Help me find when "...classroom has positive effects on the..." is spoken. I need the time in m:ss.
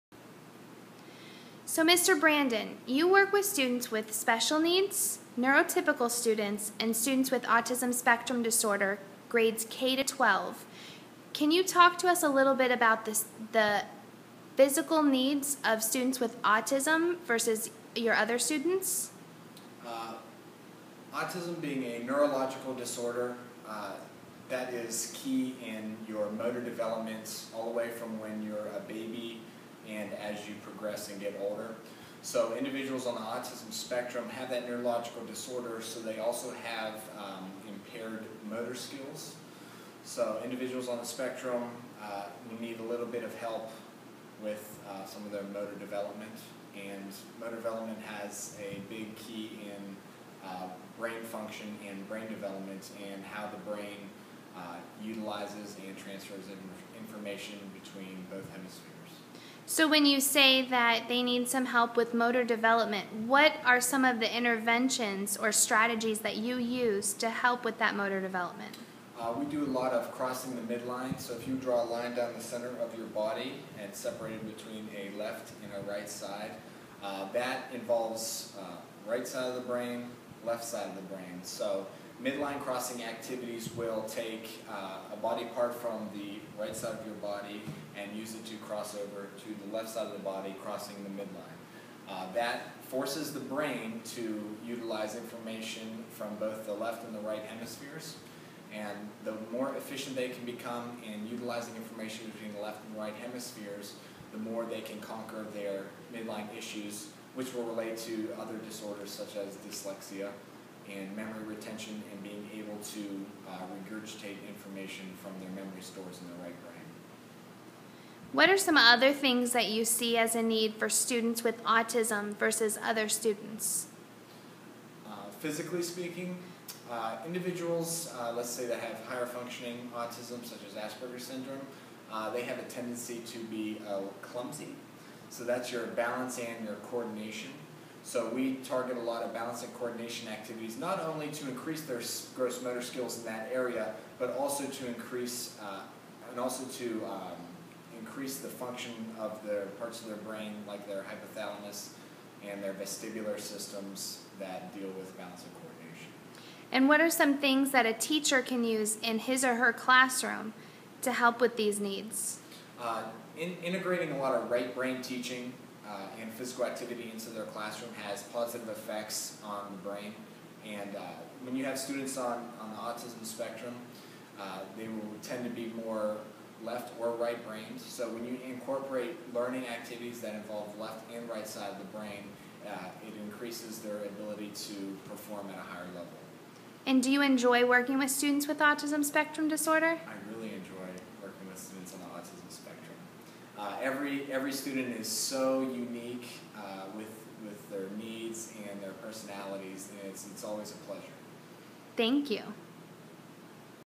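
2:47.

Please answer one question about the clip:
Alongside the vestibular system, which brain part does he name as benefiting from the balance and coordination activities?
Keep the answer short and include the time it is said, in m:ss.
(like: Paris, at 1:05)
hypothalamus, at 2:31.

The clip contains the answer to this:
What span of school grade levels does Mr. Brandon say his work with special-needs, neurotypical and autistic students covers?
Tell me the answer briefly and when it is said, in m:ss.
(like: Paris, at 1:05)
K to 12, at 0:09.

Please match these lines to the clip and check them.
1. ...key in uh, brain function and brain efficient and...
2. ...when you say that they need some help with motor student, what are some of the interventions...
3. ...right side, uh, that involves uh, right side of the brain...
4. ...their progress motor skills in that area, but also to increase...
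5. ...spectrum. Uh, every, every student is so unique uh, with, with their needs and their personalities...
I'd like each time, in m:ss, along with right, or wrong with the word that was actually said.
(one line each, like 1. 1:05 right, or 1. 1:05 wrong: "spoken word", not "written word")
1. 0:49 wrong: "development", not "efficient"
2. 0:59 wrong: "development", not "student"
3. 1:15 right
4. 2:21 wrong: "gross", not "progress"
5. 3:12 right.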